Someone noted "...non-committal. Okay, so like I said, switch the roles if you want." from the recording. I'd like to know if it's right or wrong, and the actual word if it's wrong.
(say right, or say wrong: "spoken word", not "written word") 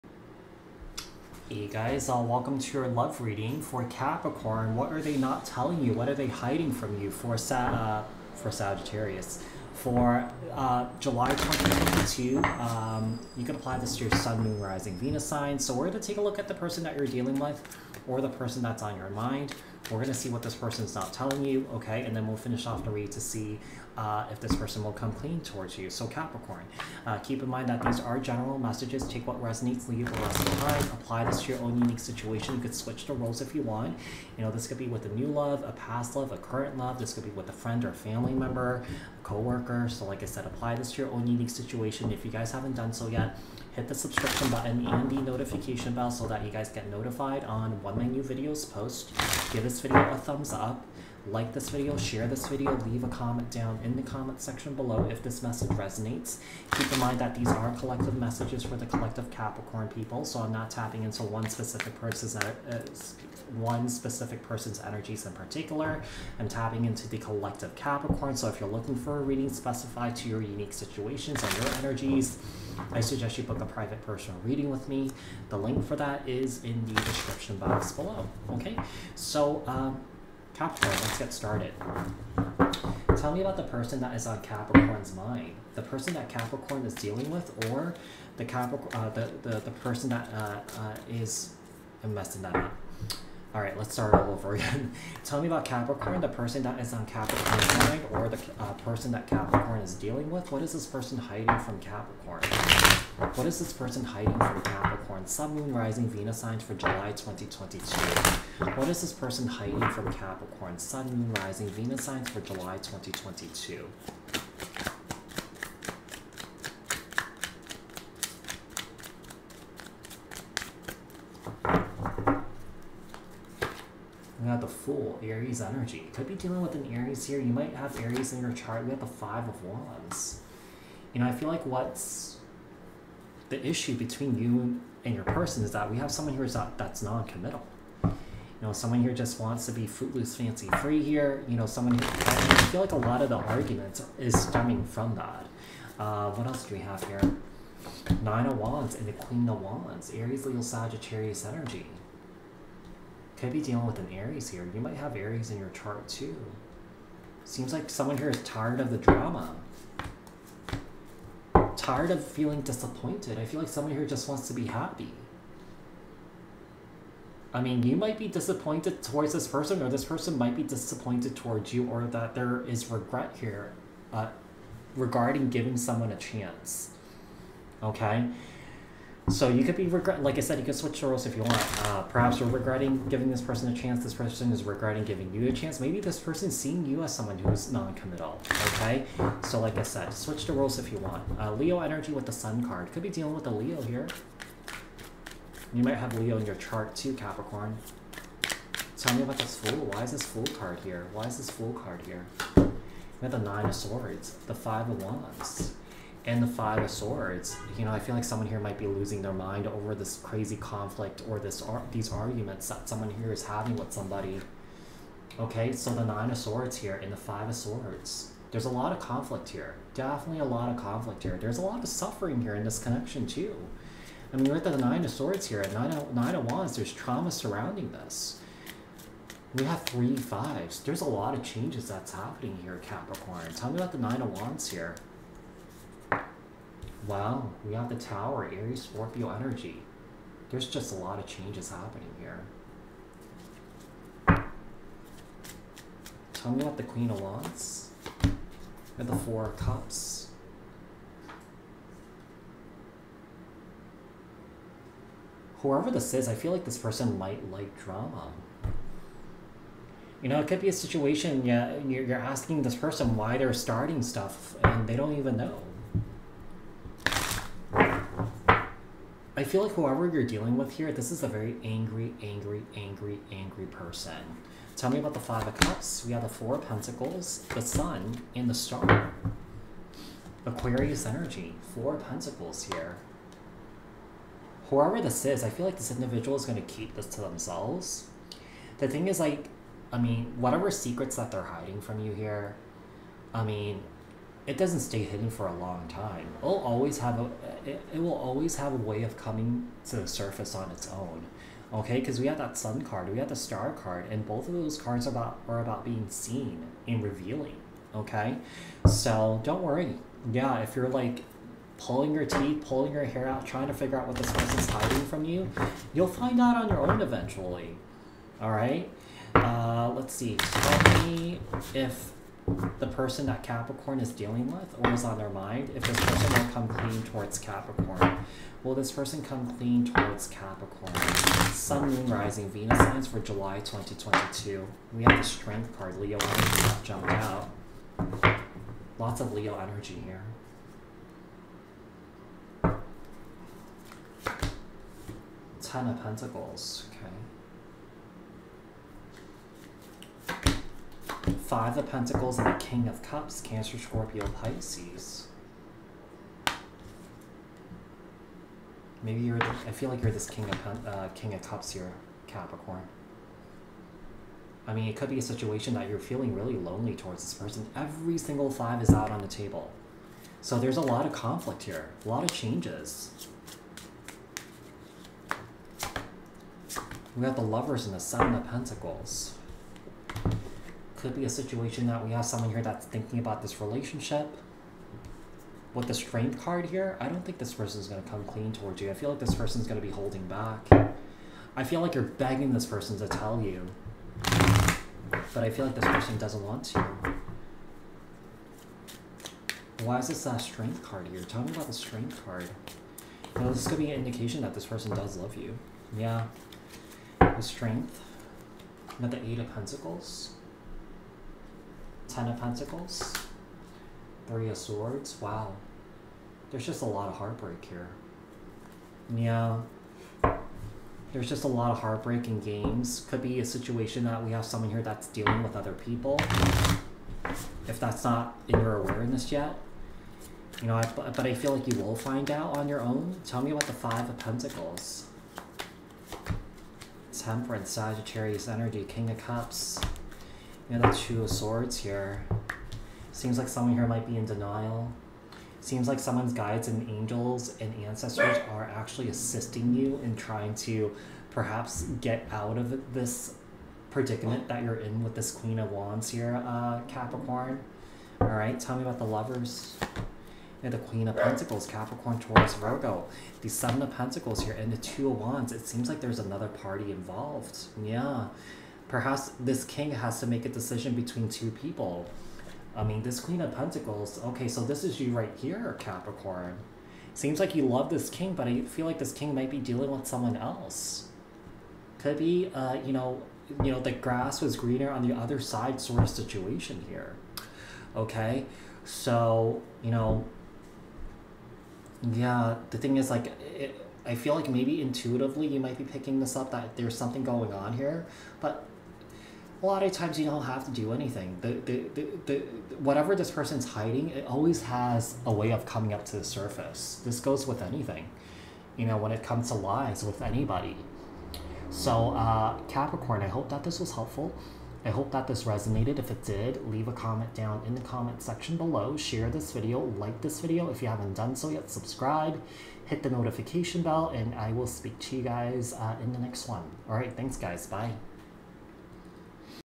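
right.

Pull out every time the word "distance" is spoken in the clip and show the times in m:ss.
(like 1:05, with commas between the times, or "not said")
not said.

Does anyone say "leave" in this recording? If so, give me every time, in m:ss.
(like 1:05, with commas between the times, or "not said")
0:29, 0:52, 8:36.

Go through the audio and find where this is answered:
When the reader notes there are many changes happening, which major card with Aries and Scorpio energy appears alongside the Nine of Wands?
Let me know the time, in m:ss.
3:57.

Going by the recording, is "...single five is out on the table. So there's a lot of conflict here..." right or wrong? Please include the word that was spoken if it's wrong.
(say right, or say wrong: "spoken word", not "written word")
right.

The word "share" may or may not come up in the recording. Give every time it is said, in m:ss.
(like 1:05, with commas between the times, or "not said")
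0:51, 8:38.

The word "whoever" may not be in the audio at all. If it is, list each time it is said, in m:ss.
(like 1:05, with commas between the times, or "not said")
4:15, 4:29, 4:44.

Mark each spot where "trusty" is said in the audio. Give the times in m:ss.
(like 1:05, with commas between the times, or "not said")
not said.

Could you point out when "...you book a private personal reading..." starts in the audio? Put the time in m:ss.
1:13.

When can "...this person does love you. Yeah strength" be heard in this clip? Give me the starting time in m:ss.
6:44.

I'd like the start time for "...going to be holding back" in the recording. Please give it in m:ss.
6:29.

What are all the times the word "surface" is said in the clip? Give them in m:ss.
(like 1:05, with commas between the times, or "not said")
5:00, 8:26.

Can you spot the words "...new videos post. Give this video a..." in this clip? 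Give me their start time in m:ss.
0:48.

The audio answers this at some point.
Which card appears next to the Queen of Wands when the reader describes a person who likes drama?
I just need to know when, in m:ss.
4:09.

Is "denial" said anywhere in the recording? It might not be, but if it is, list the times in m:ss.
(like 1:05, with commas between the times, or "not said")
7:24.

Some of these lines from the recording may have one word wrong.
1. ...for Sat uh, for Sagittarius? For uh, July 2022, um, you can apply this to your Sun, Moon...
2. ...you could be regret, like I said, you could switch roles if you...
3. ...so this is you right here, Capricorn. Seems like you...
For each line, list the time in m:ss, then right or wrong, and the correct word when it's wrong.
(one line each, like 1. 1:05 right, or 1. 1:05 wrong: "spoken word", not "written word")
1. 0:07 right
2. 2:59 right
3. 7:54 right.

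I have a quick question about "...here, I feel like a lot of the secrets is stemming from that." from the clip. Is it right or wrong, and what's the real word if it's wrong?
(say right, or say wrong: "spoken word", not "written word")
wrong: "arguments", not "secrets".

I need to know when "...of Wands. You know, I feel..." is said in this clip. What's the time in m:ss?
2:09.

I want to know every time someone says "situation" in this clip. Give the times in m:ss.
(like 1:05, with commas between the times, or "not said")
0:31, 0:41, 1:10, 4:20, 6:05, 6:21, 7:03, 8:06.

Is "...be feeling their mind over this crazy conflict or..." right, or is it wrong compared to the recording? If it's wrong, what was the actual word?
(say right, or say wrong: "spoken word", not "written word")
wrong: "losing", not "feeling".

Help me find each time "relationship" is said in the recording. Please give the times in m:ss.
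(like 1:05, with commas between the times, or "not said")
6:23.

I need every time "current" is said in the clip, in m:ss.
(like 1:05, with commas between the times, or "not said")
0:36.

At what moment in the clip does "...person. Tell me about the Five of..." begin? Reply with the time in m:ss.
4:33.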